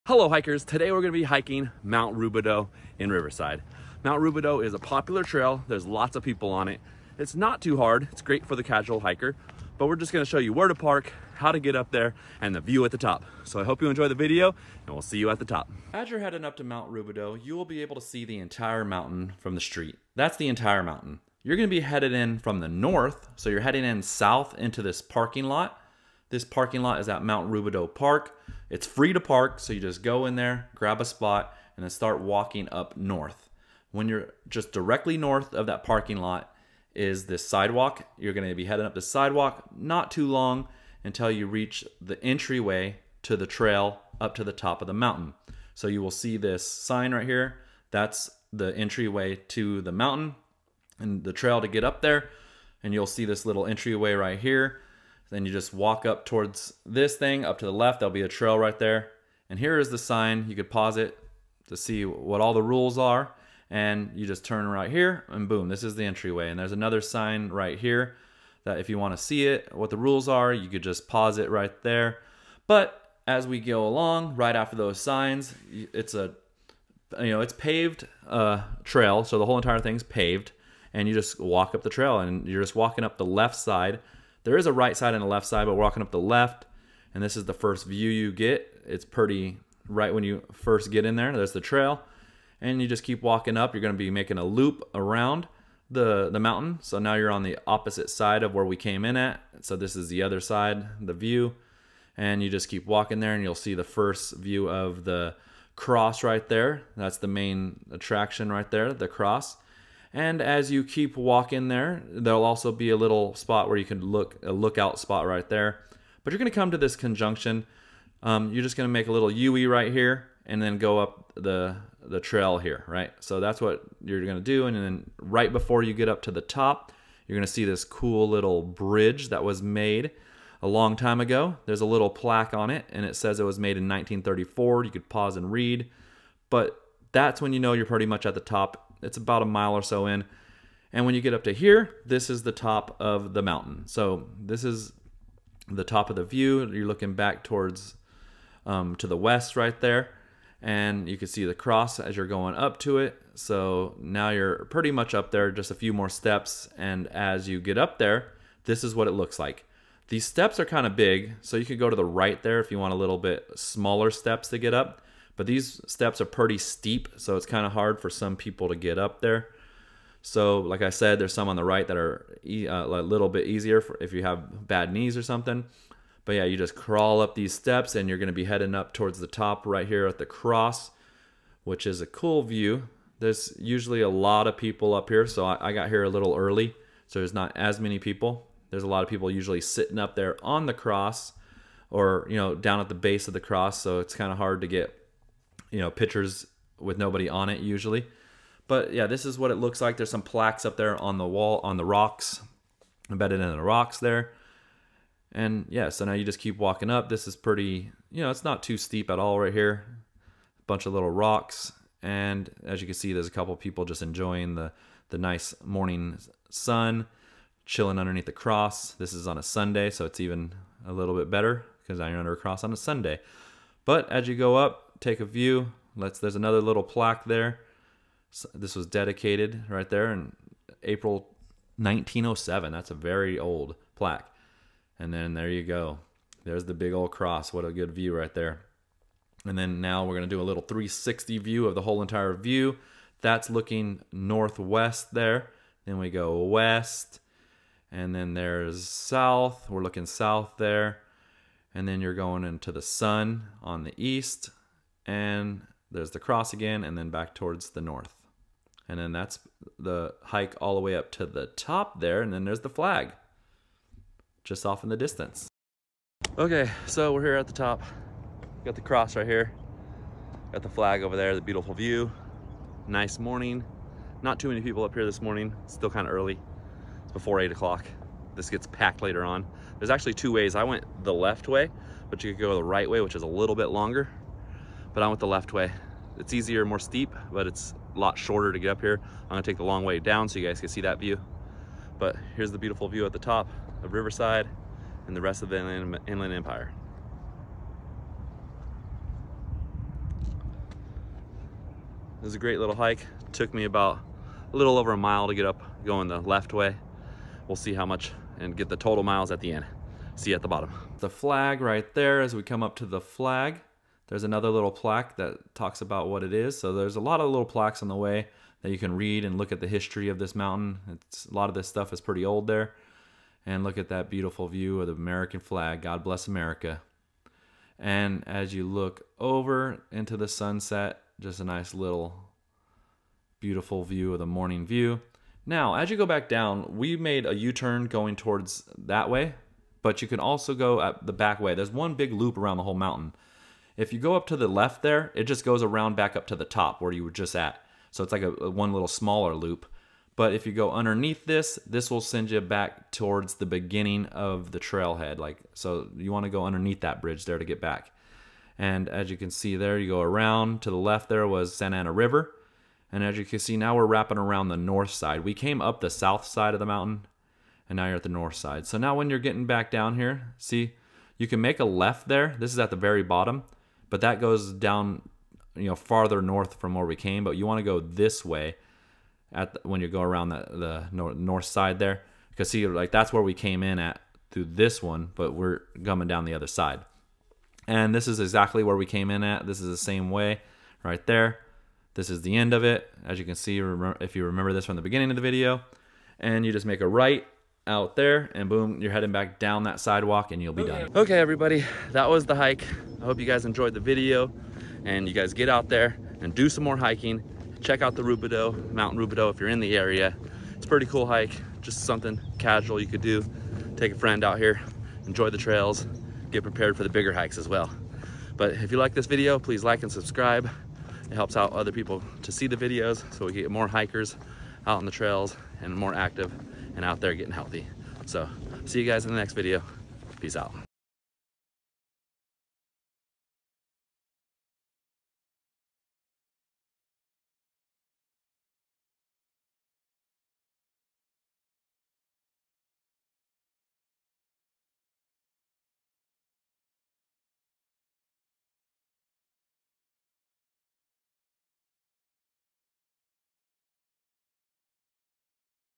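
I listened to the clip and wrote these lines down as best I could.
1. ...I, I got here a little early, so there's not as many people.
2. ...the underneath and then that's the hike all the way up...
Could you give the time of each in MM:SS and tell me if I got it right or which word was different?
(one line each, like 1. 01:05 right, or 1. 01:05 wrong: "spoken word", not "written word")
1. 03:05 right
2. 04:17 wrong: "north", not "underneath".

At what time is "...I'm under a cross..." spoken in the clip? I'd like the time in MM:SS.
03:41.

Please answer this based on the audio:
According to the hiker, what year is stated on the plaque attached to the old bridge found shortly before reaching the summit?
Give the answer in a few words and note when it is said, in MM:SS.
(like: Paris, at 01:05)
1934, at 02:13.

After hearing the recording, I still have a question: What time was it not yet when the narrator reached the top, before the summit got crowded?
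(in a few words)
8 o'clock.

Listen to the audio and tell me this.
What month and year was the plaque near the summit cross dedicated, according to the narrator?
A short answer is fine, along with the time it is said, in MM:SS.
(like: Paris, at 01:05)
April 1907, at 03:50.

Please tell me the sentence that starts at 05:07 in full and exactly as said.
We'll see how much and get the total miles at the end.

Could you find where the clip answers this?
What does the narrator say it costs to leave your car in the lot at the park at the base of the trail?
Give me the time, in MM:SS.
00:28.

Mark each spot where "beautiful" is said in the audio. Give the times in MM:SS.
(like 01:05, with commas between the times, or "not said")
04:31, 04:52, 05:24, 05:33.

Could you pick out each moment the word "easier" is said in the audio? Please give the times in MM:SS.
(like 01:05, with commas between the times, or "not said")
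02:53, 04:46.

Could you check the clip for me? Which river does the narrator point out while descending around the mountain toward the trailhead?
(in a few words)
Santa Ana River.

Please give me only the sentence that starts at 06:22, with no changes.
Because see, like that's where we came in at through this one, but we're coming down the other side.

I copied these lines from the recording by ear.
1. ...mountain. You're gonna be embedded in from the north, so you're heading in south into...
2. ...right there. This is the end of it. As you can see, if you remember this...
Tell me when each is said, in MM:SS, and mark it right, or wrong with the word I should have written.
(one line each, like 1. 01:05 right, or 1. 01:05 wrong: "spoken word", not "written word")
1. 00:20 wrong: "headed", not "embedded"
2. 06:30 right.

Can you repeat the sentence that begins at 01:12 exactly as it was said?
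But as we go along, right after those signs, it's a, you know, it's paved uh, trail.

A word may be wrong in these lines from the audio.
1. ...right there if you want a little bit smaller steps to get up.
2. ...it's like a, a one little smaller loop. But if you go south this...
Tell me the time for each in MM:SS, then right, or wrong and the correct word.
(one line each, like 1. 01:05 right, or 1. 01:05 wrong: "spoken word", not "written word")
1. 02:42 right
2. 05:48 wrong: "underneath", not "south".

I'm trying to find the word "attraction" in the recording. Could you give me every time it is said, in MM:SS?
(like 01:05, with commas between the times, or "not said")
01:47.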